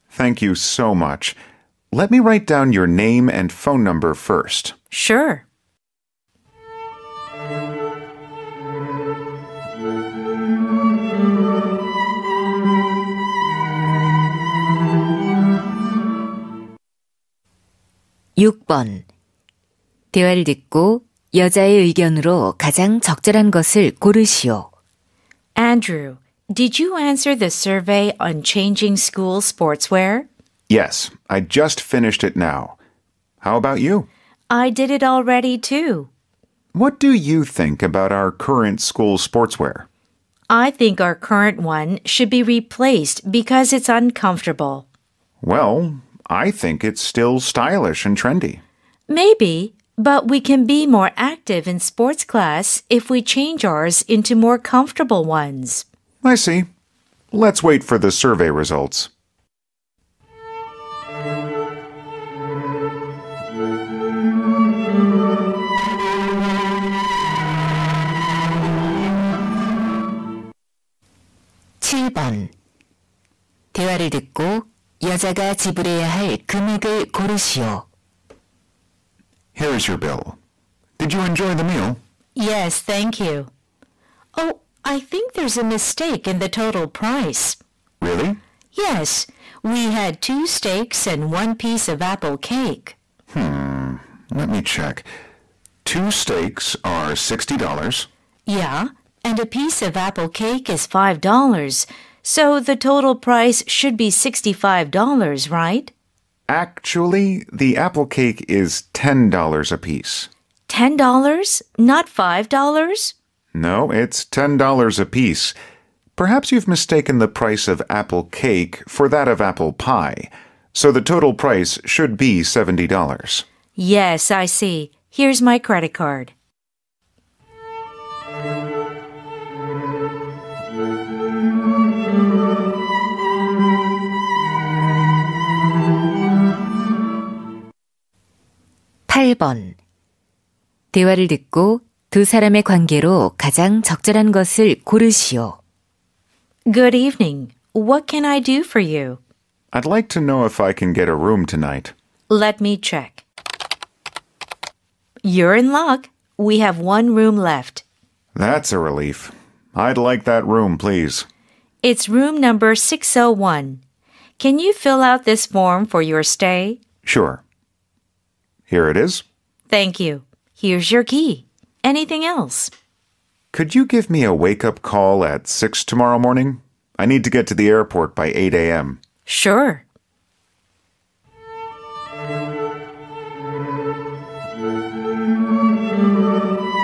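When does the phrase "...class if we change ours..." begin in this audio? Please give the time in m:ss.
0:52.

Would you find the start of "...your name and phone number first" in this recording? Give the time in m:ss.
0:02.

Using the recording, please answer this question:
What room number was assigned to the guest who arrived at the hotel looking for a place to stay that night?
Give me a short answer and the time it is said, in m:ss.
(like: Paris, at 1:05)
601, at 2:42.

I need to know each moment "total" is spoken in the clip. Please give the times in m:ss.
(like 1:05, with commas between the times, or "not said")
1:26, 1:42, 2:01.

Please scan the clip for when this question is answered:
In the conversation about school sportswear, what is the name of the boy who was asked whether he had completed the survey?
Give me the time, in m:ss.
0:25.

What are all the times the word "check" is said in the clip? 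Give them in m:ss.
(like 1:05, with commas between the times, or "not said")
1:34, 2:32.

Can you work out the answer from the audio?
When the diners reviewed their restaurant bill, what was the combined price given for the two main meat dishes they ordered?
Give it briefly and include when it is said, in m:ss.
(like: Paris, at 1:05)
$60, at 1:37.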